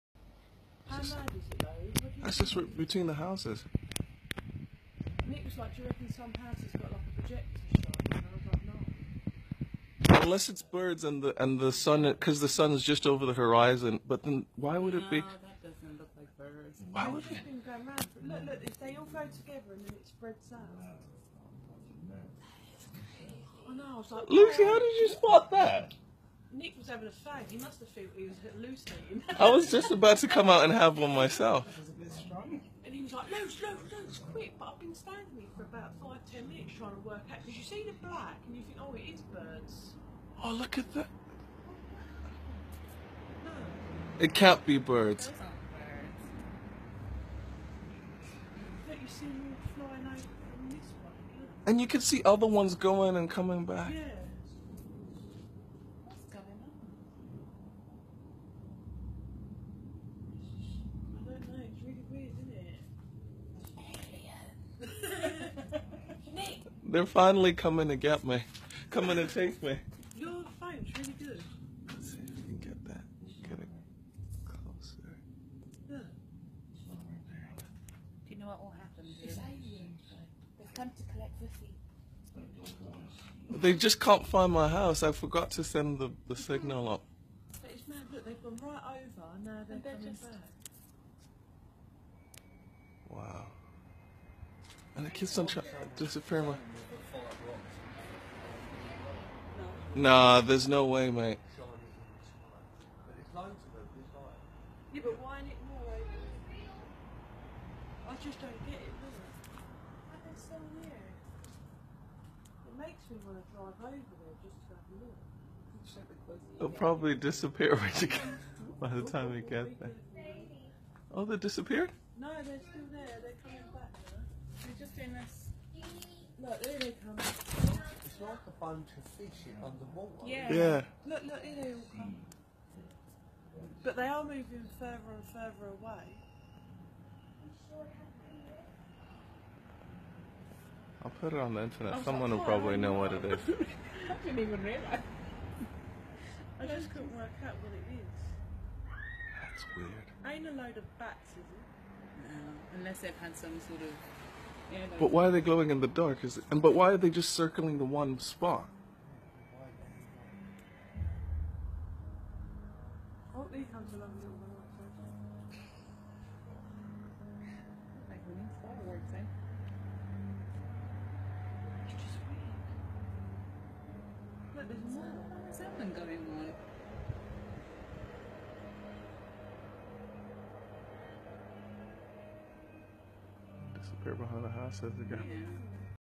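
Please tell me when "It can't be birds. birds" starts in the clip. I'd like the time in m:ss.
0:44.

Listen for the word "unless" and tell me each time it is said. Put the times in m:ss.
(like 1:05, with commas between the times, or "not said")
0:10, 2:32.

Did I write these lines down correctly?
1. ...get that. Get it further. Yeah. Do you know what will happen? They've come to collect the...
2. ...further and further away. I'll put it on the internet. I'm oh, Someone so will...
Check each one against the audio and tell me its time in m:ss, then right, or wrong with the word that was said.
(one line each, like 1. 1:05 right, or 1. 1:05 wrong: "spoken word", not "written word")
1. 1:12 wrong: "closer", not "further"
2. 2:14 right.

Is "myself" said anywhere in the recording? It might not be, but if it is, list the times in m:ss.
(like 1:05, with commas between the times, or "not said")
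0:31.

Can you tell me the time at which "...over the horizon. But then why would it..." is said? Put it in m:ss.
0:13.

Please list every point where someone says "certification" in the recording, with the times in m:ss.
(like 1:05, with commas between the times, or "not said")
not said.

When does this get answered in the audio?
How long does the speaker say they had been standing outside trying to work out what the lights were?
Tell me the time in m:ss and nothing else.
0:36.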